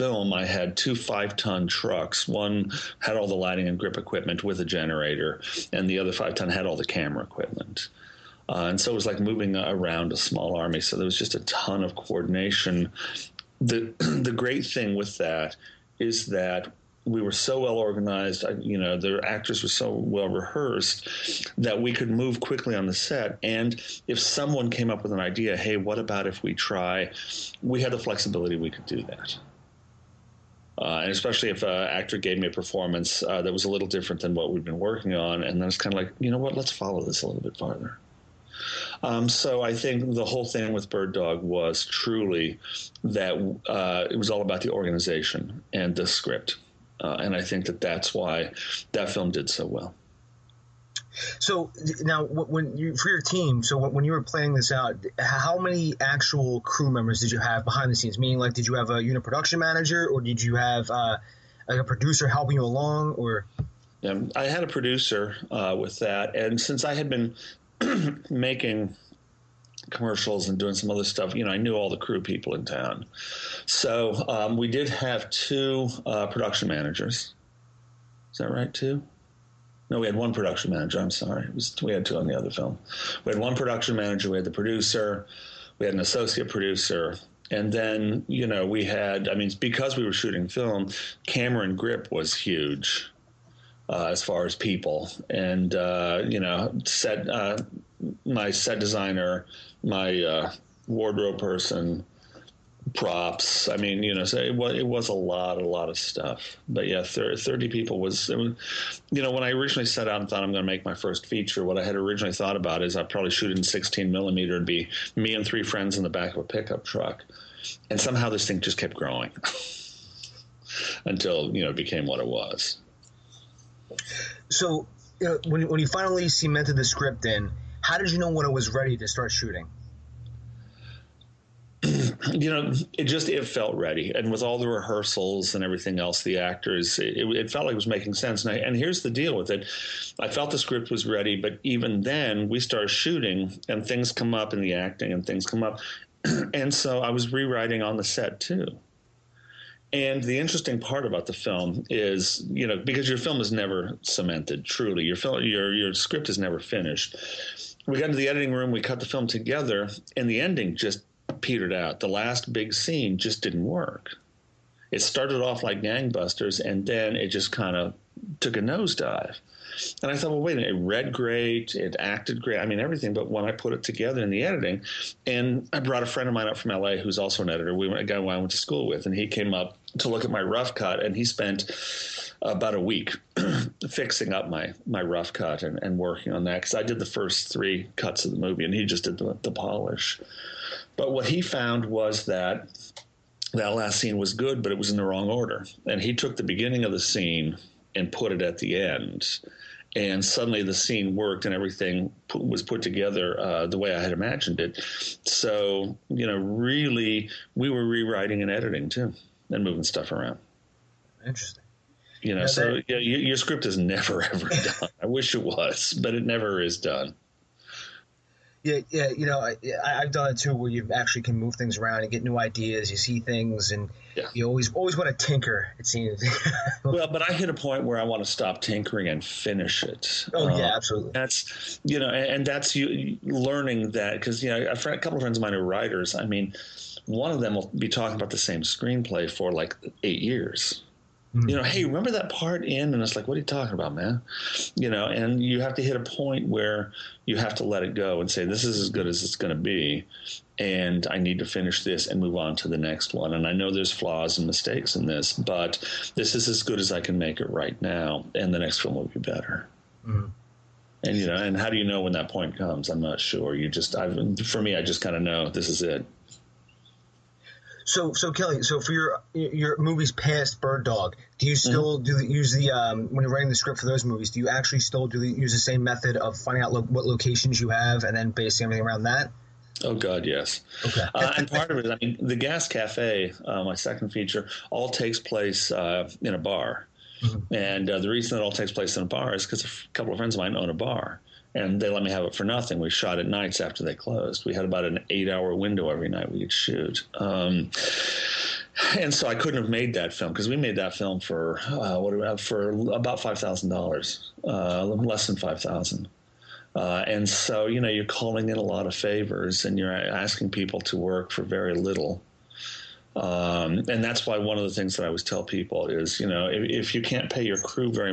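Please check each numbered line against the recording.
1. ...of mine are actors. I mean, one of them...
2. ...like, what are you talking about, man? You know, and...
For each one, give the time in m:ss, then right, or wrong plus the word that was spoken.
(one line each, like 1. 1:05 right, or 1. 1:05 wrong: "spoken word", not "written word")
1. 3:55 wrong: "writers", not "actors"
2. 4:03 right.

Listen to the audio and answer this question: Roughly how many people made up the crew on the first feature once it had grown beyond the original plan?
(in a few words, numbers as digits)
30.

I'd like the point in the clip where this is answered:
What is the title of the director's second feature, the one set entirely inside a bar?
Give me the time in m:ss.
4:42.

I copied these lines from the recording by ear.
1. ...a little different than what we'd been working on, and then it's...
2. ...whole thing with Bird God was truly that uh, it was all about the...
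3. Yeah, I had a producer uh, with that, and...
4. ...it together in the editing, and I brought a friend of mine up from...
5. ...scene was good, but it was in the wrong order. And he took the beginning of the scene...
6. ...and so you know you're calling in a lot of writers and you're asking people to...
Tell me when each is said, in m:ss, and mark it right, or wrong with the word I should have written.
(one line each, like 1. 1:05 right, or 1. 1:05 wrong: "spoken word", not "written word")
1. 0:33 right
2. 0:40 wrong: "Dog", not "God"
3. 1:04 right
4. 2:53 right
5. 3:13 right
6. 5:07 wrong: "favors", not "writers".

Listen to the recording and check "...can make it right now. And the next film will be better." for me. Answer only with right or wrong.
right.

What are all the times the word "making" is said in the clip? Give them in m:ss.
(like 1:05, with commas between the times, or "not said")
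1:08, 2:17.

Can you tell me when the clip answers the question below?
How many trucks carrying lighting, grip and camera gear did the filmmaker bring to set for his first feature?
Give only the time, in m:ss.
0:00.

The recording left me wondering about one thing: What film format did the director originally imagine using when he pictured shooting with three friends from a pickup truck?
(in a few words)
16 millimeter.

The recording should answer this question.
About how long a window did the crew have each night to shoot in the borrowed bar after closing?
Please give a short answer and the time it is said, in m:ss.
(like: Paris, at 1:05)
8 hours, at 4:55.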